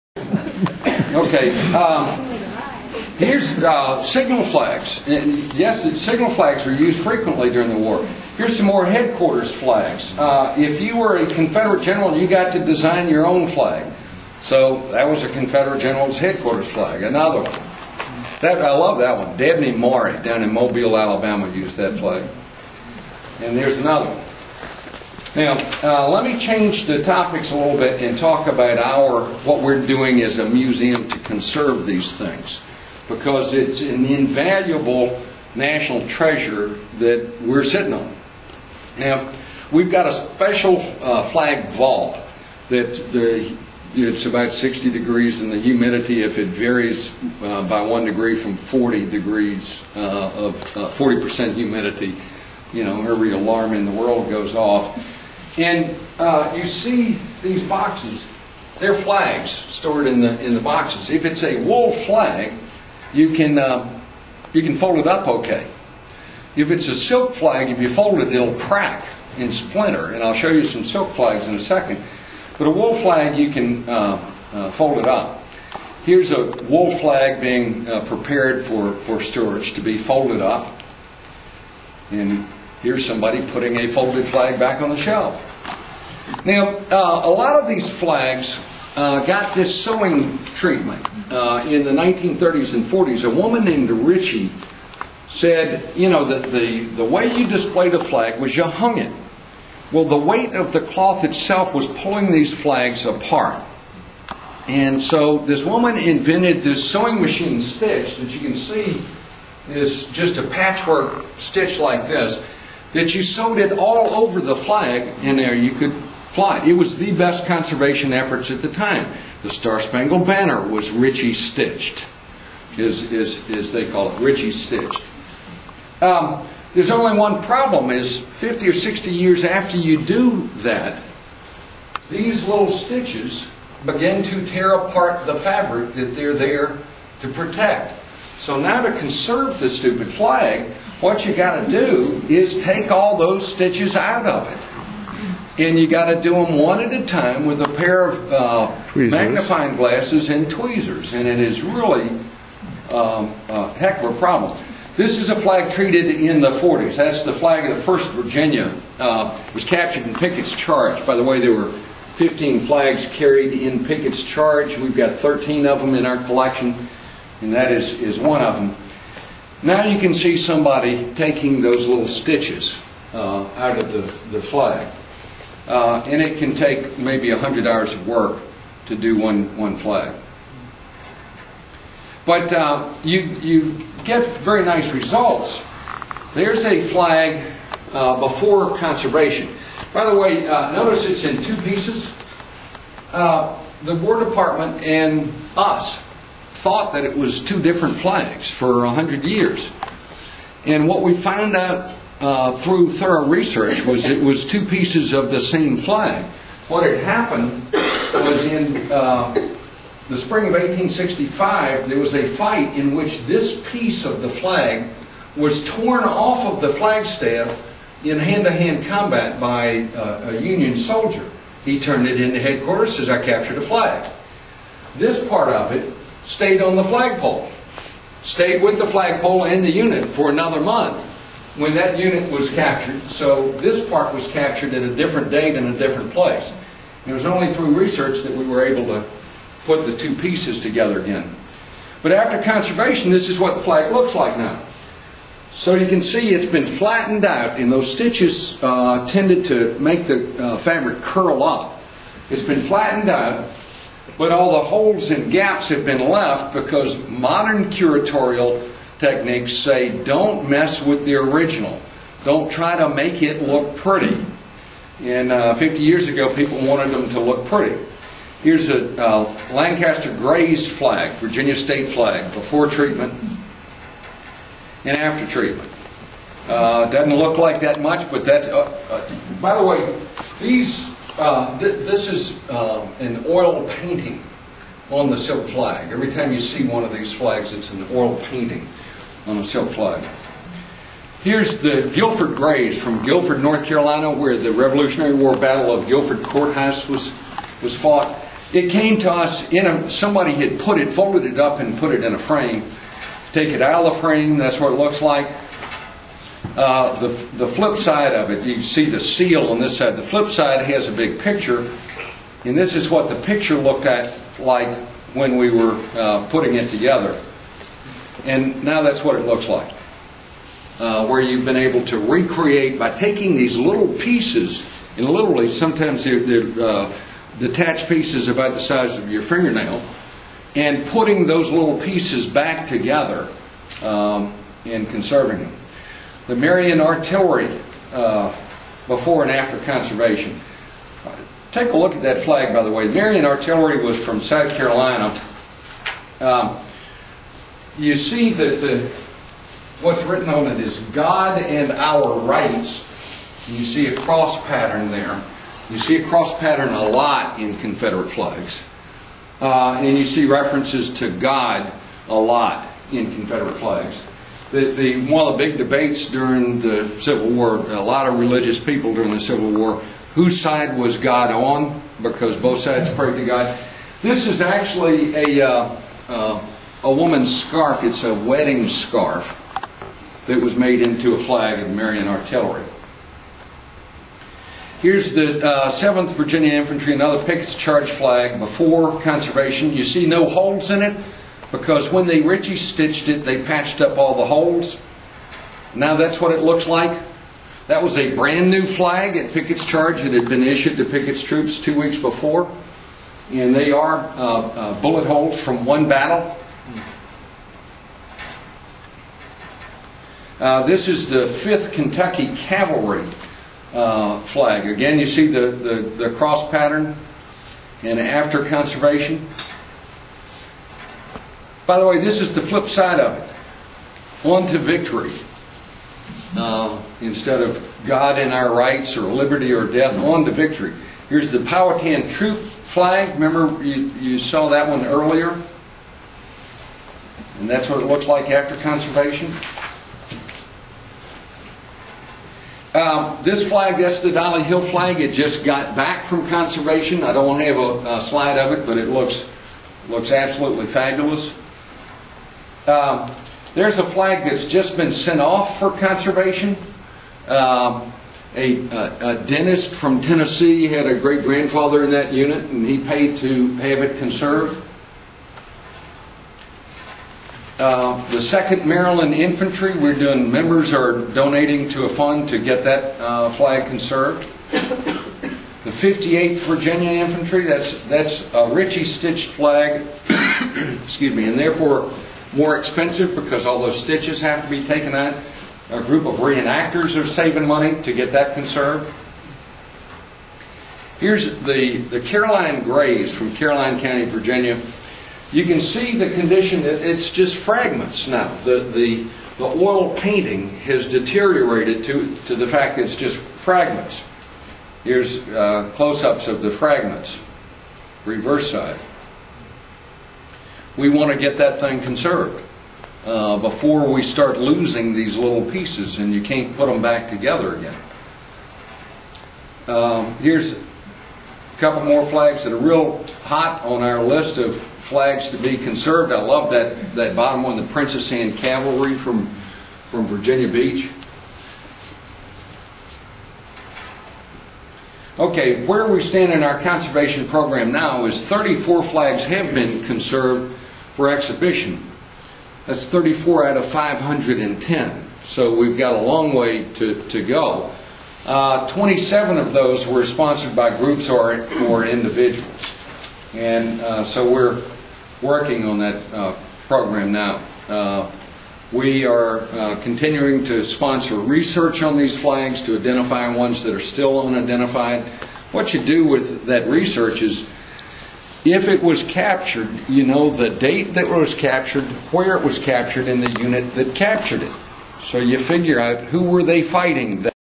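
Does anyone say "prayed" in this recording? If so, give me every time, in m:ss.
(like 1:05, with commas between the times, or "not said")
6:12.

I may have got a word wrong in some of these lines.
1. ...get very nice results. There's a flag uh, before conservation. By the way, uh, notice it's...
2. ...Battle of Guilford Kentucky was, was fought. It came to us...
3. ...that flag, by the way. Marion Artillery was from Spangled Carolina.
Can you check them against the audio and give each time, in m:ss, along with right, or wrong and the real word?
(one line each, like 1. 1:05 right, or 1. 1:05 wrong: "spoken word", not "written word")
1. 3:04 right
2. 4:55 wrong: "Courthouse", not "Kentucky"
3. 5:42 wrong: "South", not "Spangled".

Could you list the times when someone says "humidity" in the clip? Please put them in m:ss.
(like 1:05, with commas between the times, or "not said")
0:45, 0:51.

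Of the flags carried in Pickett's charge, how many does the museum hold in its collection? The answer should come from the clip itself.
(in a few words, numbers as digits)
13.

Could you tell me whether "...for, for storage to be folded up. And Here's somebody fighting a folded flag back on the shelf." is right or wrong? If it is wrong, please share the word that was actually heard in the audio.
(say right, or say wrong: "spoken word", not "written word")
wrong: "putting", not "fighting".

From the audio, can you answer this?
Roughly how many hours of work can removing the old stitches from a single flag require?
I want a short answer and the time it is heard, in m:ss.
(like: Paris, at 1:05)
100 hours, at 2:57.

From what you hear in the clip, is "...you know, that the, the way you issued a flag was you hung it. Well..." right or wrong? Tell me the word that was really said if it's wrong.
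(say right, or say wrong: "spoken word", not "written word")
wrong: "displayed", not "issued".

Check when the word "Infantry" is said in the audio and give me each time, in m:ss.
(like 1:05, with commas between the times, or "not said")
6:26, 7:49, 7:56.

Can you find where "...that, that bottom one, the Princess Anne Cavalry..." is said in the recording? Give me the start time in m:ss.
8:46.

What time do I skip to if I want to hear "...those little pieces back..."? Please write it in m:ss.
5:31.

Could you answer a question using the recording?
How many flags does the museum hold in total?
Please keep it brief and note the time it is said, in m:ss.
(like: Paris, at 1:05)
510, at 9:03.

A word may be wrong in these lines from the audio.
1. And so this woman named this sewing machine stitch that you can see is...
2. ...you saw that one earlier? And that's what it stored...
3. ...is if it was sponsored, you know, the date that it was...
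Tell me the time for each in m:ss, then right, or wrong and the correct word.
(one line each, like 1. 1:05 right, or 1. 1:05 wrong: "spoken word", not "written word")
1. 1:44 wrong: "invented", not "named"
2. 7:14 wrong: "looked", not "stored"
3. 9:27 wrong: "captured", not "sponsored".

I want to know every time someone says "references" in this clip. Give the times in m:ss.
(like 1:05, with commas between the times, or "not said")
6:00.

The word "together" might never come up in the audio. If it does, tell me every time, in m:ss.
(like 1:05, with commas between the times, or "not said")
4:00, 5:16, 5:32, 8:37.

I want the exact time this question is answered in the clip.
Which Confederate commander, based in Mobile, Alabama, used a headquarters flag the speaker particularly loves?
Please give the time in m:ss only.
0:19.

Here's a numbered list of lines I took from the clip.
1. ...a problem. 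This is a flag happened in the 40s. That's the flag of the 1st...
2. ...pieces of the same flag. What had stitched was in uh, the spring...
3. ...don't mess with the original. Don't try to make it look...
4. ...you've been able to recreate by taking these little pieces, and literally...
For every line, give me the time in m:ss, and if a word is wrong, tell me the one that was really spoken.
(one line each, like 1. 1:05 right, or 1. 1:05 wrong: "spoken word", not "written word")
1. 2:34 wrong: "treated", not "happened"
2. 3:24 wrong: "happened", not "stitched"
3. 4:20 right
4. 5:21 right.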